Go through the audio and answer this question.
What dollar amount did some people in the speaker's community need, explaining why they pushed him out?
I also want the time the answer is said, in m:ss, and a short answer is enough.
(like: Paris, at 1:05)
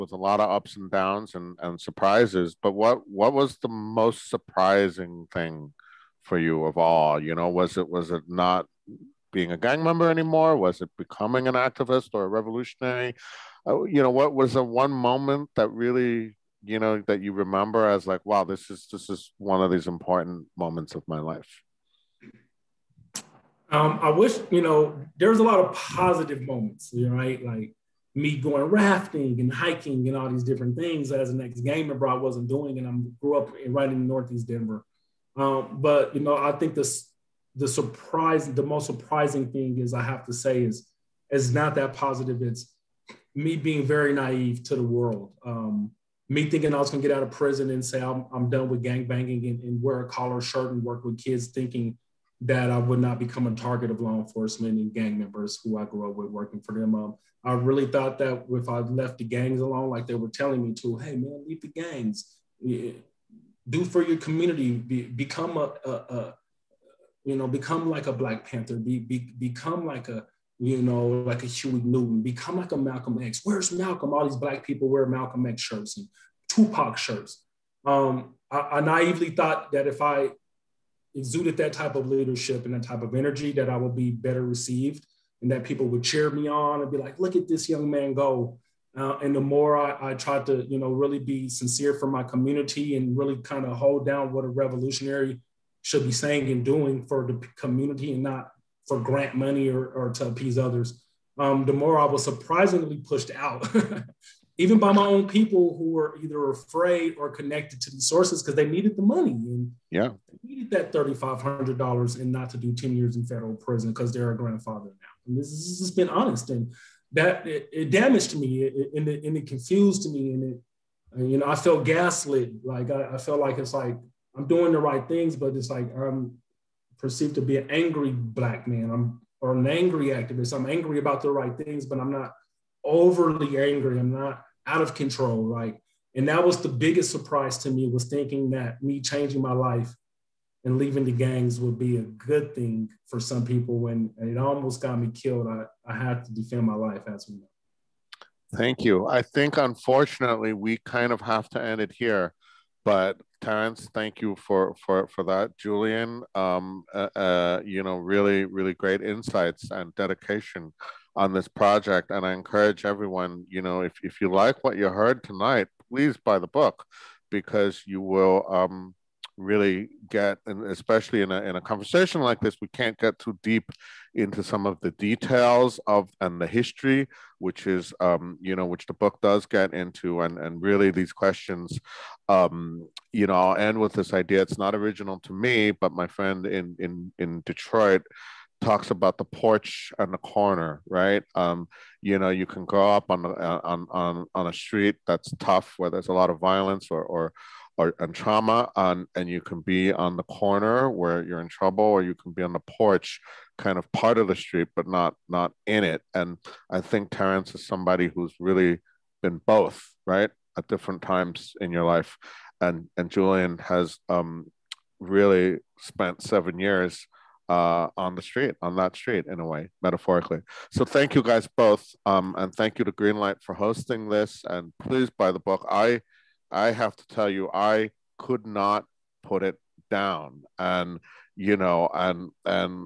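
$3500, at 1:50.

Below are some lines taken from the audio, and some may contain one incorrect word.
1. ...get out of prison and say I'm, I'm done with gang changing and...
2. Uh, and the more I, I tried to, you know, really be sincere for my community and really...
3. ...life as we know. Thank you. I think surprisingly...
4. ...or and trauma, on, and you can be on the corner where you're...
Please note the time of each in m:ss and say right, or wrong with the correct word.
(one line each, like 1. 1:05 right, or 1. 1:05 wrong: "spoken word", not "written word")
1. 0:47 wrong: "banging", not "changing"
2. 1:28 right
3. 2:26 wrong: "unfortunately", not "surprisingly"
4. 3:17 right.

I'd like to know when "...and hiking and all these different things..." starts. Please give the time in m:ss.
0:29.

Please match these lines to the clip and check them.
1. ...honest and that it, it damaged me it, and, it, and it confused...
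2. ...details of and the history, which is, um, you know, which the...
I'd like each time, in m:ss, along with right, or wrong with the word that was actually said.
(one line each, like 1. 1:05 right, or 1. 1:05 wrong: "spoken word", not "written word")
1. 1:56 right
2. 2:54 right.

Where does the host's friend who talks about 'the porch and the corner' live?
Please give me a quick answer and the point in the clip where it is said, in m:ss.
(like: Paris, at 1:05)
Detroit, at 3:07.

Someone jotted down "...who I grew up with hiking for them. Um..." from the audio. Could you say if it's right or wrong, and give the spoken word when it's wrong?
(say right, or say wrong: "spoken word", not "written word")
wrong: "working", not "hiking".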